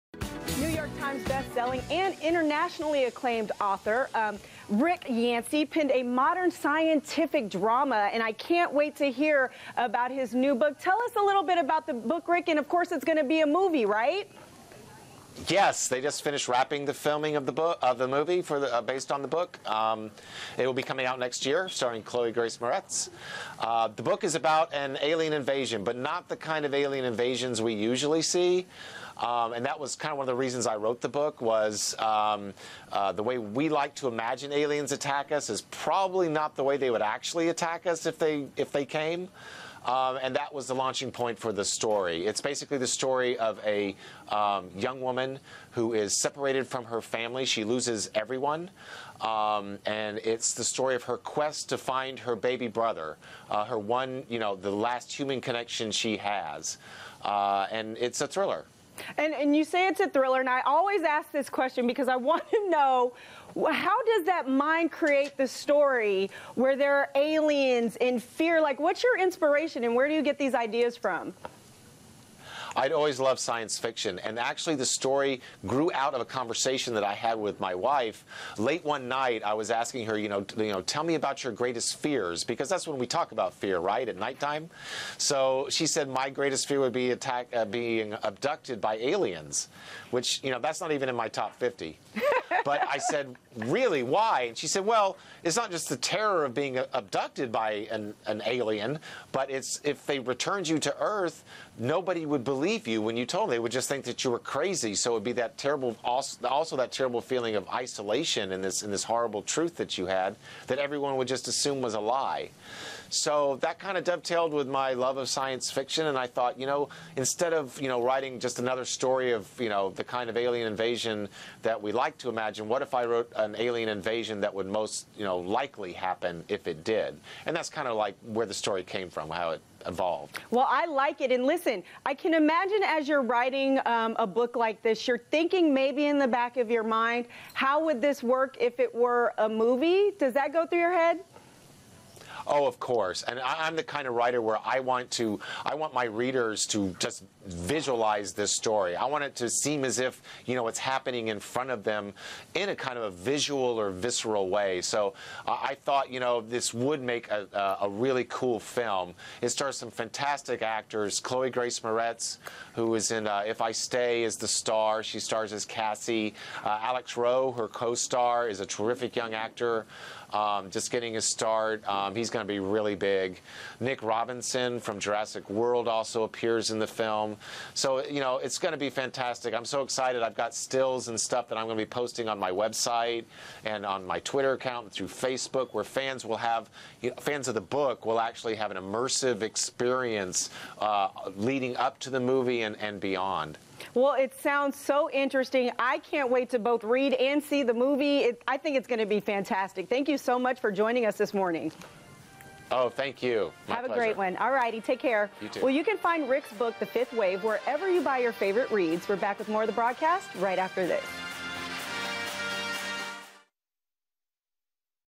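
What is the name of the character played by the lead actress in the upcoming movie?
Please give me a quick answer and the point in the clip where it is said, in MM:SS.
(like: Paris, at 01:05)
Cassie, at 02:45.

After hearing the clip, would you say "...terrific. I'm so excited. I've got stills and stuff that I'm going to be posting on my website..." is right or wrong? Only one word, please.
wrong.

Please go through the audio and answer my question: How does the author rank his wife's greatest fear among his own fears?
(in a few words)
50.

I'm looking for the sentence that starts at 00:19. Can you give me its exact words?
Um, it will be coming out next year, starring Chloe Grace Moretz.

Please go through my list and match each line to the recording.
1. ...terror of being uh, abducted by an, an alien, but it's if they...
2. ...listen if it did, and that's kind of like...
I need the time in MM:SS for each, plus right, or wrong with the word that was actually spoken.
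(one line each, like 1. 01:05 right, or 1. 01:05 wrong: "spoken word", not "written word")
1. 01:35 right
2. 02:05 wrong: "happen", not "listen".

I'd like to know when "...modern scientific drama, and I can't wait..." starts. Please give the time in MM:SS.
00:06.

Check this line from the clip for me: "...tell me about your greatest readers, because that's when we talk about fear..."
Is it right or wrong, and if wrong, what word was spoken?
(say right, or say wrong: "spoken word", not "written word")
wrong: "fears", not "readers".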